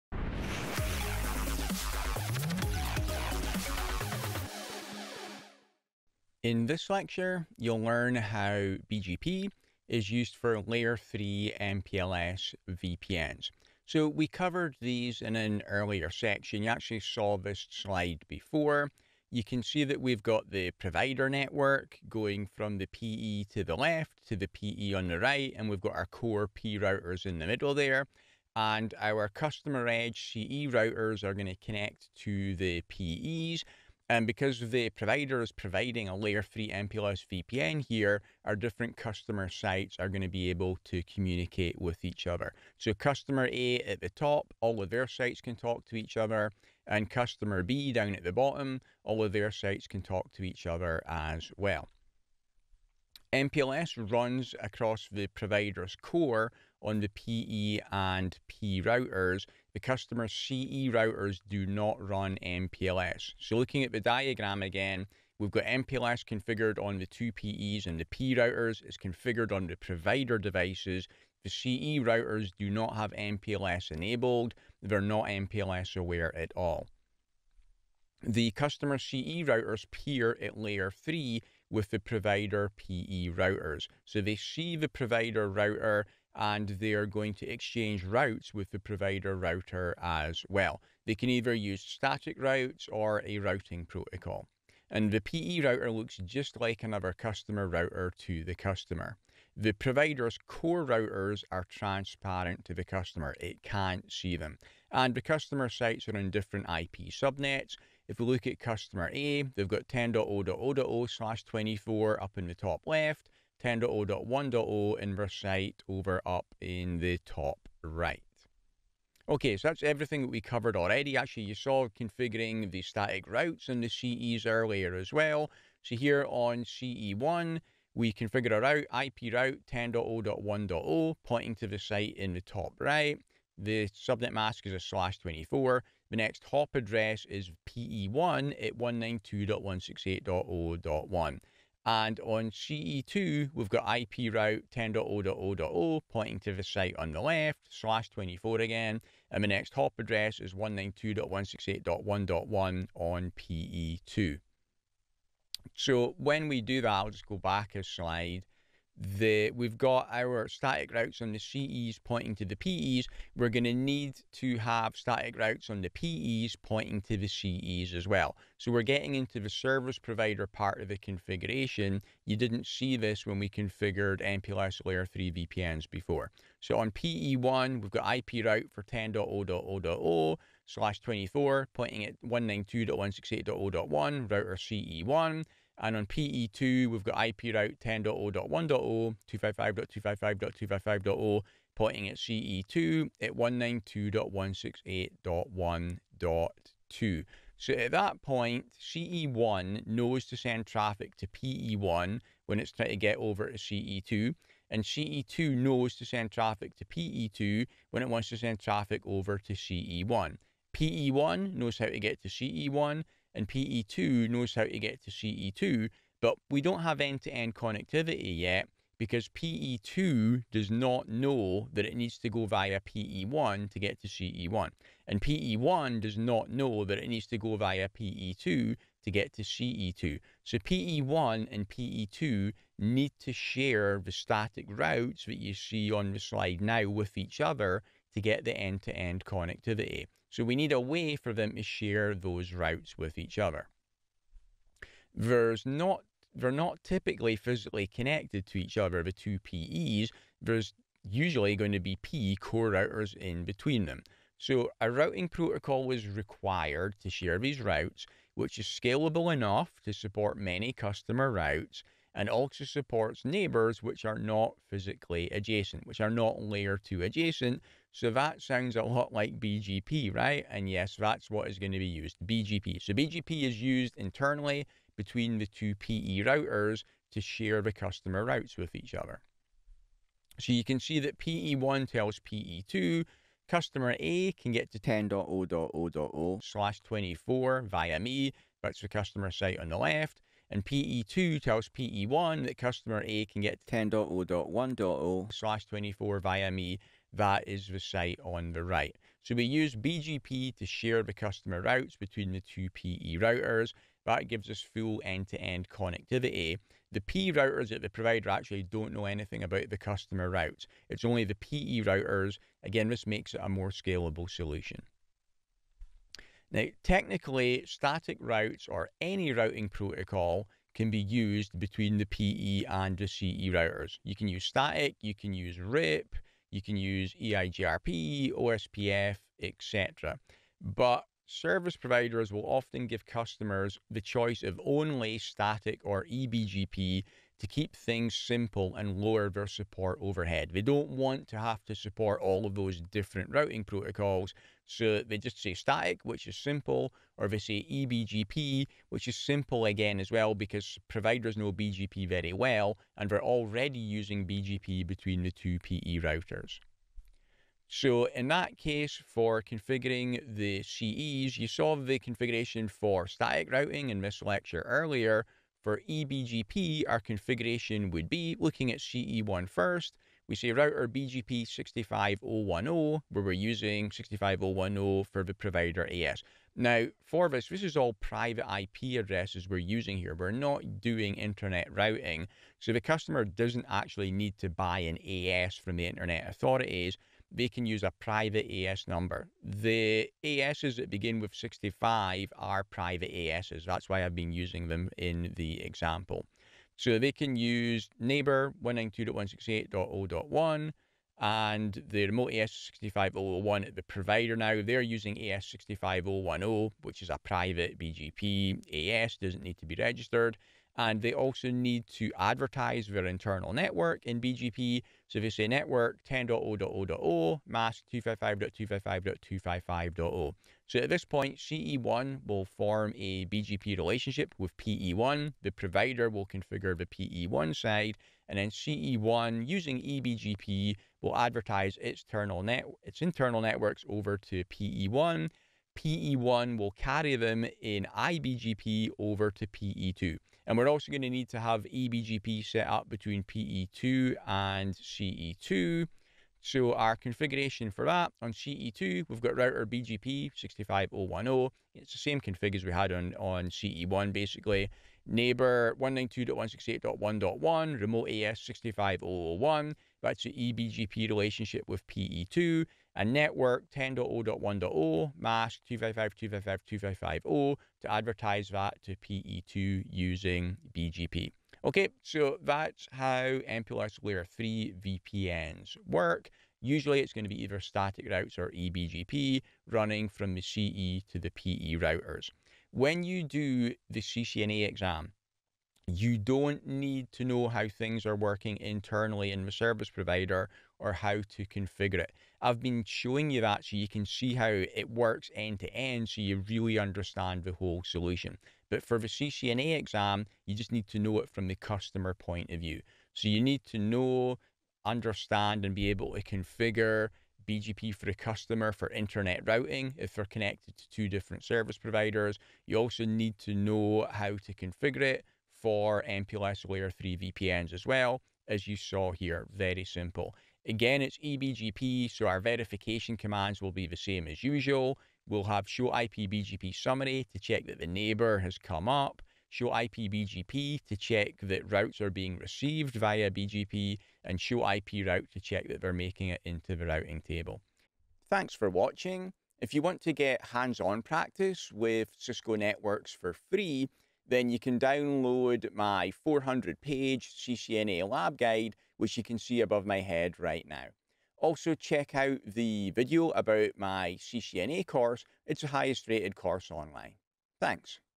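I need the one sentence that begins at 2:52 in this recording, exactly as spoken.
You didn't see this when we configured MPLS layer 3 VPNs before.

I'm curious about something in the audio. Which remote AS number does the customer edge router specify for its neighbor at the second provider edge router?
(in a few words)
65001.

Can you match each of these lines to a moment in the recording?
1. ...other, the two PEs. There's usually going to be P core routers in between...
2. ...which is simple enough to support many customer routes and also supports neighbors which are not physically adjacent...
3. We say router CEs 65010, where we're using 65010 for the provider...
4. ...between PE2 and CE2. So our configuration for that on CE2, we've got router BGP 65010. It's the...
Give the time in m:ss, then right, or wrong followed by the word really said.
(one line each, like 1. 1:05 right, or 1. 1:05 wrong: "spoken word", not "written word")
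1. 4:08 right
2. 4:18 wrong: "scalable", not "simple"
3. 6:10 wrong: "BGP", not "CEs"
4. 7:22 right.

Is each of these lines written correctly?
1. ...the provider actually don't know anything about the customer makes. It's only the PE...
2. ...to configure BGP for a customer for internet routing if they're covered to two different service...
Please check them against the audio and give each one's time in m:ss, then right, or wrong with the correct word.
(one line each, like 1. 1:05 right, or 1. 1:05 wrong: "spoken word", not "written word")
1. 5:07 wrong: "routes", not "makes"
2. 8:26 wrong: "connected", not "covered".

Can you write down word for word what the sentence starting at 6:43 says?
the provider now, they're using AS65010, which is a private BGP AS, doesn't need to be registered.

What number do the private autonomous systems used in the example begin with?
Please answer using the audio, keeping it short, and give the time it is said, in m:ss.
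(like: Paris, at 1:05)
65, at 6:31.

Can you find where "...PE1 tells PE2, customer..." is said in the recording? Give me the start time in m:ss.
4:41.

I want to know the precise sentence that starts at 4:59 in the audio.
So we use BGP to share the customer routes between the two PE routers.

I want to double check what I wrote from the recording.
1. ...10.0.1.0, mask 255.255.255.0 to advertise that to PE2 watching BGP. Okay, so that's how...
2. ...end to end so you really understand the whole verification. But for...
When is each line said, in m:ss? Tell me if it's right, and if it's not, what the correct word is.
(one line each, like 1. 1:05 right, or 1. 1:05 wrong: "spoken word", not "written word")
1. 7:43 wrong: "using", not "watching"
2. 8:15 wrong: "solution", not "verification".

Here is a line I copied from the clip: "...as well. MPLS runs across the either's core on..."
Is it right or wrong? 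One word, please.
wrong.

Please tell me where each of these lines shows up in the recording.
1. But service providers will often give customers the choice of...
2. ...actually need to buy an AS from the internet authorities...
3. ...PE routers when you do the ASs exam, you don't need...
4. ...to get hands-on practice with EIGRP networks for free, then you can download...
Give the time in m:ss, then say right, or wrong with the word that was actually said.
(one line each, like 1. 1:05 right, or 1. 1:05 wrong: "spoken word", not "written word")
1. 5:30 right
2. 6:23 right
3. 8:01 wrong: "CCNA", not "ASs"
4. 9:00 wrong: "Cisco", not "EIGRP".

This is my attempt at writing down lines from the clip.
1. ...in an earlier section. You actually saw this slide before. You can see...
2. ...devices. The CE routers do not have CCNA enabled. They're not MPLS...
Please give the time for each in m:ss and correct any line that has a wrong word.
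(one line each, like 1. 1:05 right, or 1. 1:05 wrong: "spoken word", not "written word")
1. 0:15 right
2. 1:10 wrong: "MPLS", not "CCNA".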